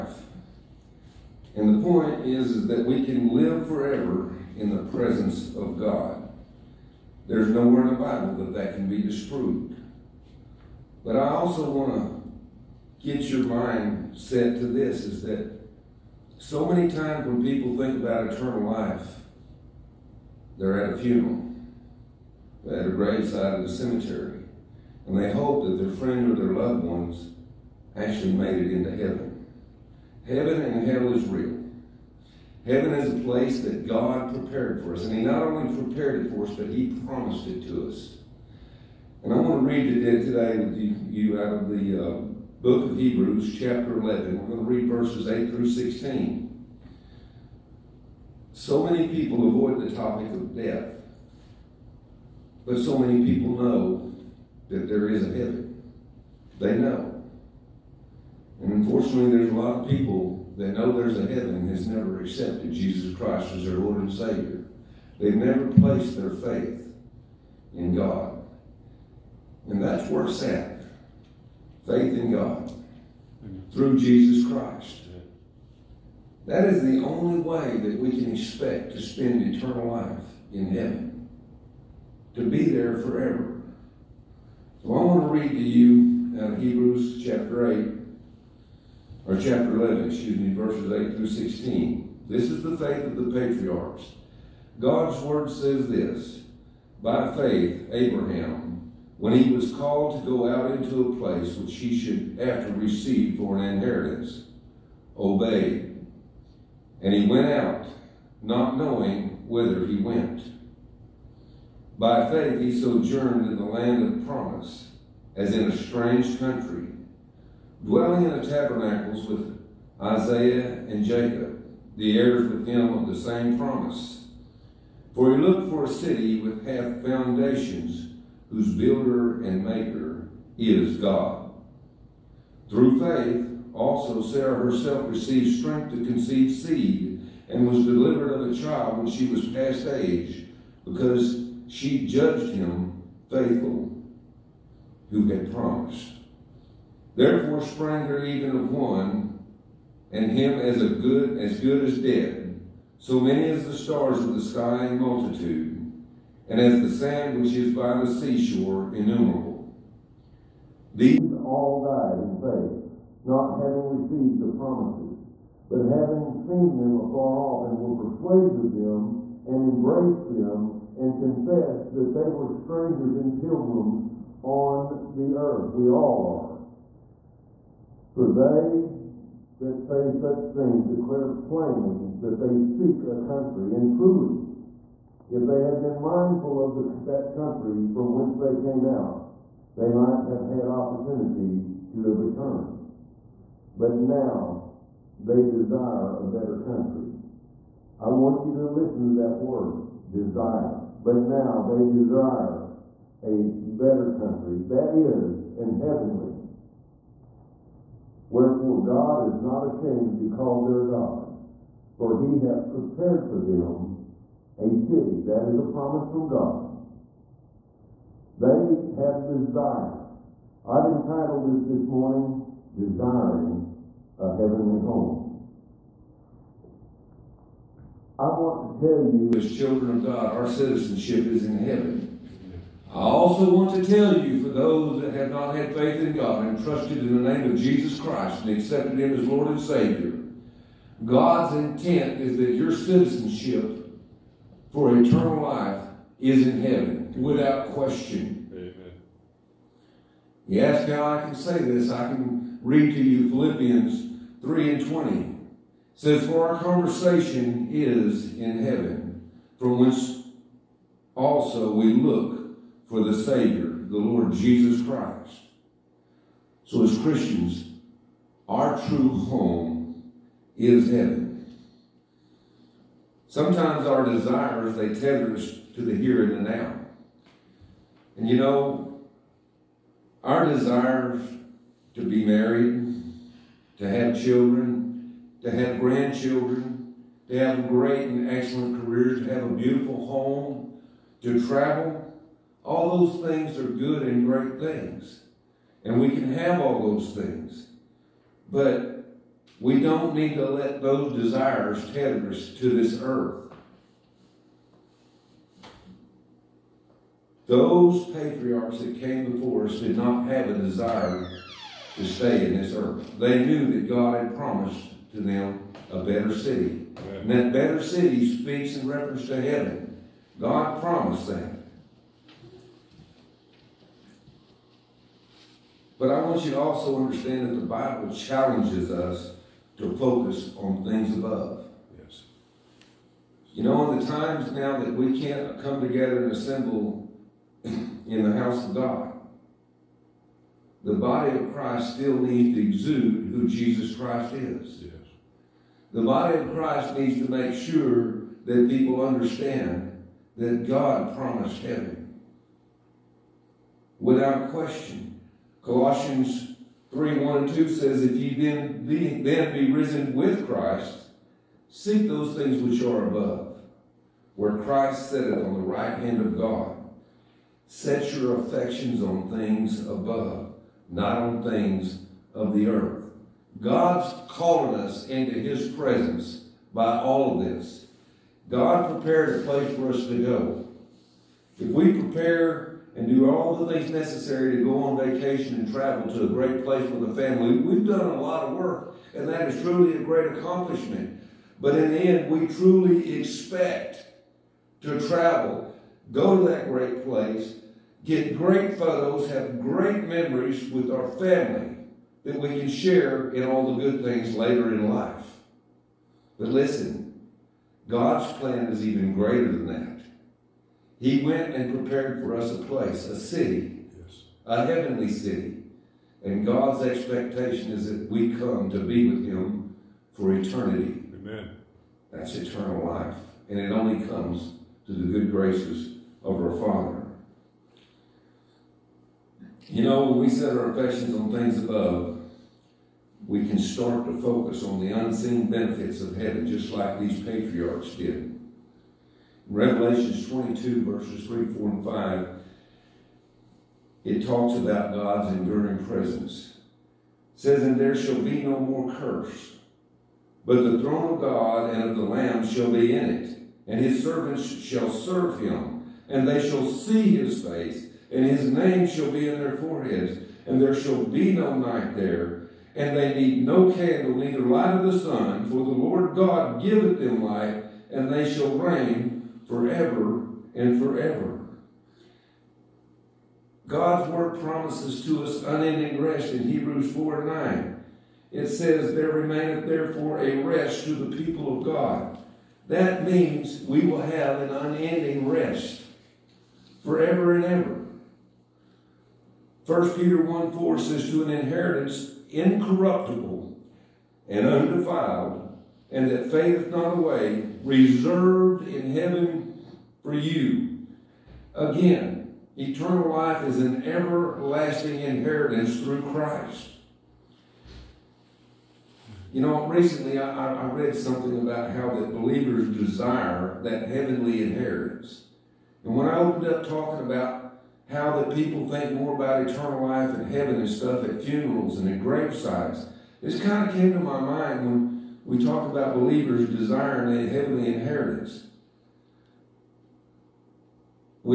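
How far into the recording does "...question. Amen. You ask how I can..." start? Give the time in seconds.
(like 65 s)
247 s.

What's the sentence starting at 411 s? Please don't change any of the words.
He went and prepared for us a place, a city, yes.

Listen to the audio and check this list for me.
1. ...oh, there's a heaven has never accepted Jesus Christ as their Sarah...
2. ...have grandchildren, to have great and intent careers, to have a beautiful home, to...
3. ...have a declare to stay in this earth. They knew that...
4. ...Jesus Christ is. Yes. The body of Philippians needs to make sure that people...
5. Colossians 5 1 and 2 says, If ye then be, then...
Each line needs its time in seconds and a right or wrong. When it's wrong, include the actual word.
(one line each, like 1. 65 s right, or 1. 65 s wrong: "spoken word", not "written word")
1. 60 s wrong: "Lord", not "Sarah"
2. 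285 s wrong: "excellent", not "intent"
3. 310 s wrong: "desire", not "declare"
4. 343 s wrong: "Christ", not "Philippians"
5. 355 s wrong: "3", not "5".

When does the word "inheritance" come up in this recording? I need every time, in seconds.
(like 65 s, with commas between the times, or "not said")
103 s, 491 s, 504 s, 514 s, 527 s.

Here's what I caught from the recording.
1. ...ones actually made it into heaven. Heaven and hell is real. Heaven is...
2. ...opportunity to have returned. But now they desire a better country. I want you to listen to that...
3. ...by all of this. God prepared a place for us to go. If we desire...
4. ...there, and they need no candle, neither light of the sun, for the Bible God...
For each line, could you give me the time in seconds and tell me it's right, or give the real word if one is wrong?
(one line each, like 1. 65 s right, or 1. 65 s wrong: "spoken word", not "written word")
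1. 26 s right
2. 190 s right
3. 376 s wrong: "prepare", not "desire"
4. 461 s wrong: "Lord", not "Bible".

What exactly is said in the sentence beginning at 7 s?
There's nowhere in the Bible that that can be disproved.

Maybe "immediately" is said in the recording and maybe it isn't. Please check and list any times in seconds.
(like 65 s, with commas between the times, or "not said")
not said.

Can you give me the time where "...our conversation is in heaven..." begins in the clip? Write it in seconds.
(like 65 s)
256 s.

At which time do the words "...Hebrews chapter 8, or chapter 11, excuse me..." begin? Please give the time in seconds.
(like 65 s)
86 s.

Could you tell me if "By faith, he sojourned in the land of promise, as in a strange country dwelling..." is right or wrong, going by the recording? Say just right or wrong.
right.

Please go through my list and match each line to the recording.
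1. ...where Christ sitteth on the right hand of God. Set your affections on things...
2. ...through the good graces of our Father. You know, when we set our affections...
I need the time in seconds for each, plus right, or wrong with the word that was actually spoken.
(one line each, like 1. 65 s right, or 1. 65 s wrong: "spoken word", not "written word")
1. 364 s right
2. 424 s right.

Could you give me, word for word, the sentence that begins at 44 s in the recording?
We're going to read verses 8 through 16.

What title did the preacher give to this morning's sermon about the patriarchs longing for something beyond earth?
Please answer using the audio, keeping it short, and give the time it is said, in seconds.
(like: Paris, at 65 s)
Desiring a Heavenly Home, at 222 s.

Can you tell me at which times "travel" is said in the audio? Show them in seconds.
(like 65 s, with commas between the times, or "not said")
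291 s, 385 s, 395 s.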